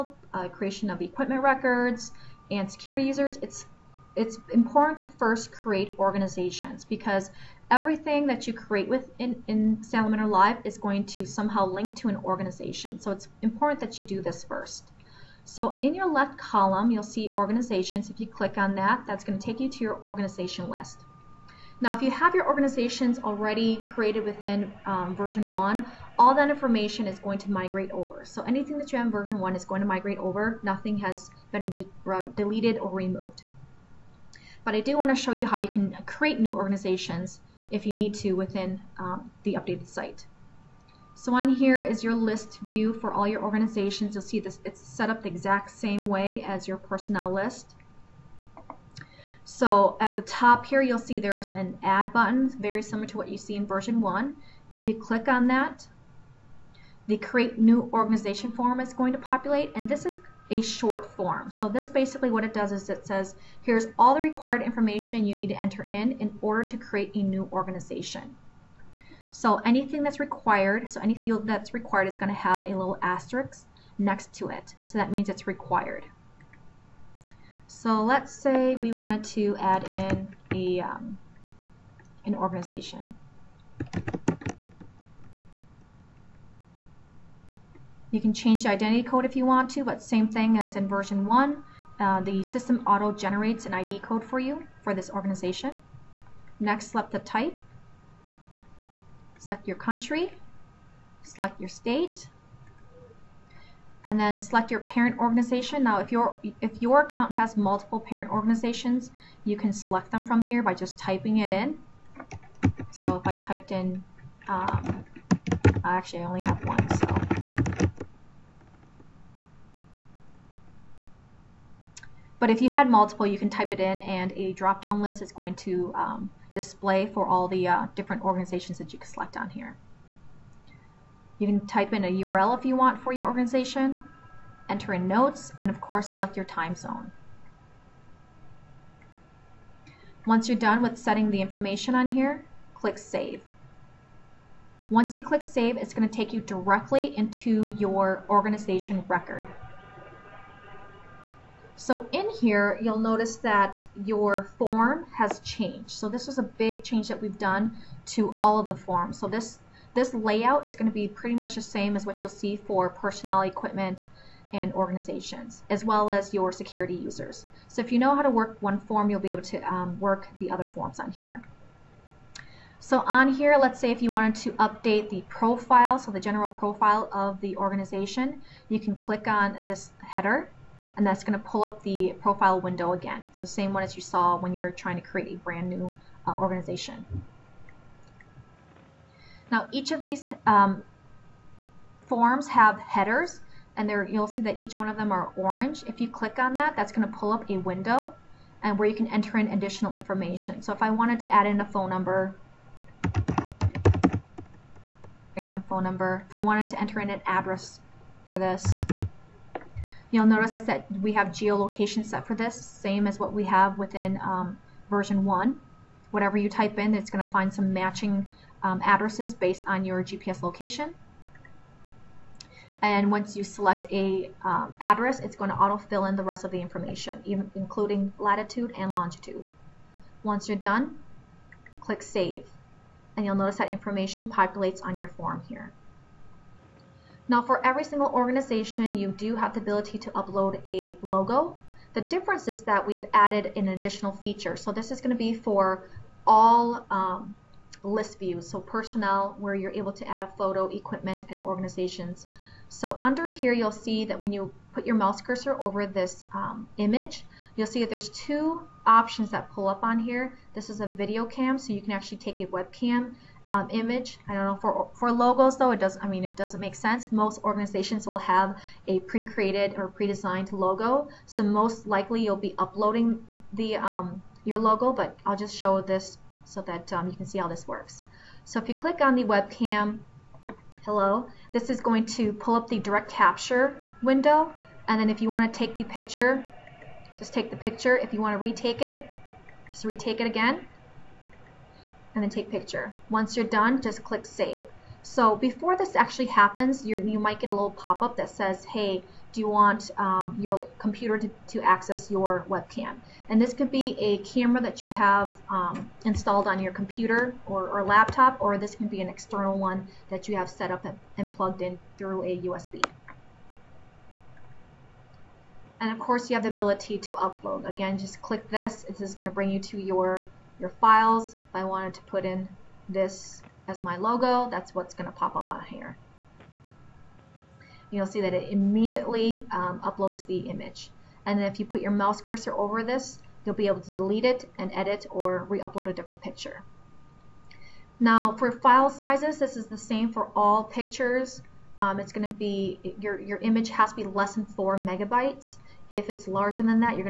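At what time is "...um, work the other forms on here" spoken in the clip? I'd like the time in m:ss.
2:49.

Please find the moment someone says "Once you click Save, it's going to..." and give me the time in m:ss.
2:24.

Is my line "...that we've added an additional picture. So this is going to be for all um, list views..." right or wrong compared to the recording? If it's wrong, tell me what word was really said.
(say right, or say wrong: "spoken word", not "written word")
wrong: "feature", not "picture".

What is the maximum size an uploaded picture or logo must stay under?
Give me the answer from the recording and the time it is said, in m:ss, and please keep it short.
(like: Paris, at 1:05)
4 megabytes, at 5:44.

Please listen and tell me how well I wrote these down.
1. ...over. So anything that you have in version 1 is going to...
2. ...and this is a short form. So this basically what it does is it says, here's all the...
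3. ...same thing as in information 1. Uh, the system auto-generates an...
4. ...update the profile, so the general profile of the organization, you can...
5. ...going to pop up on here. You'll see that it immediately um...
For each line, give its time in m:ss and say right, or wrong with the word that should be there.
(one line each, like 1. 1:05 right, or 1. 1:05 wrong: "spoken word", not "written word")
1. 0:27 right
2. 0:59 right
3. 1:30 wrong: "version", not "information"
4. 2:54 right
5. 5:24 right.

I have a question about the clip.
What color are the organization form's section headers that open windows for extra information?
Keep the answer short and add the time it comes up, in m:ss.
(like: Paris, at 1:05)
orange, at 3:15.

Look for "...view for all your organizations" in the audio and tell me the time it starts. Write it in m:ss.
0:42.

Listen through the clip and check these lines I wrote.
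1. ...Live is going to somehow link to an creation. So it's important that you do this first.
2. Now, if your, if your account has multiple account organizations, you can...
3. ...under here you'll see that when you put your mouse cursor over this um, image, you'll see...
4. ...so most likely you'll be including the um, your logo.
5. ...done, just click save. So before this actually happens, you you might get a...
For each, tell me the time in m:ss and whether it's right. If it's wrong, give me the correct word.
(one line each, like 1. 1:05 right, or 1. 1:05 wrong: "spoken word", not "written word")
1. 0:10 wrong: "organization", not "creation"
2. 1:45 wrong: "parent", not "account"
3. 4:13 right
4. 4:31 wrong: "uploading", not "including"
5. 4:53 right.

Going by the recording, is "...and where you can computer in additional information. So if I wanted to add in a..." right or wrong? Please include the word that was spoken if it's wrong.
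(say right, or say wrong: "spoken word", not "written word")
wrong: "enter", not "computer".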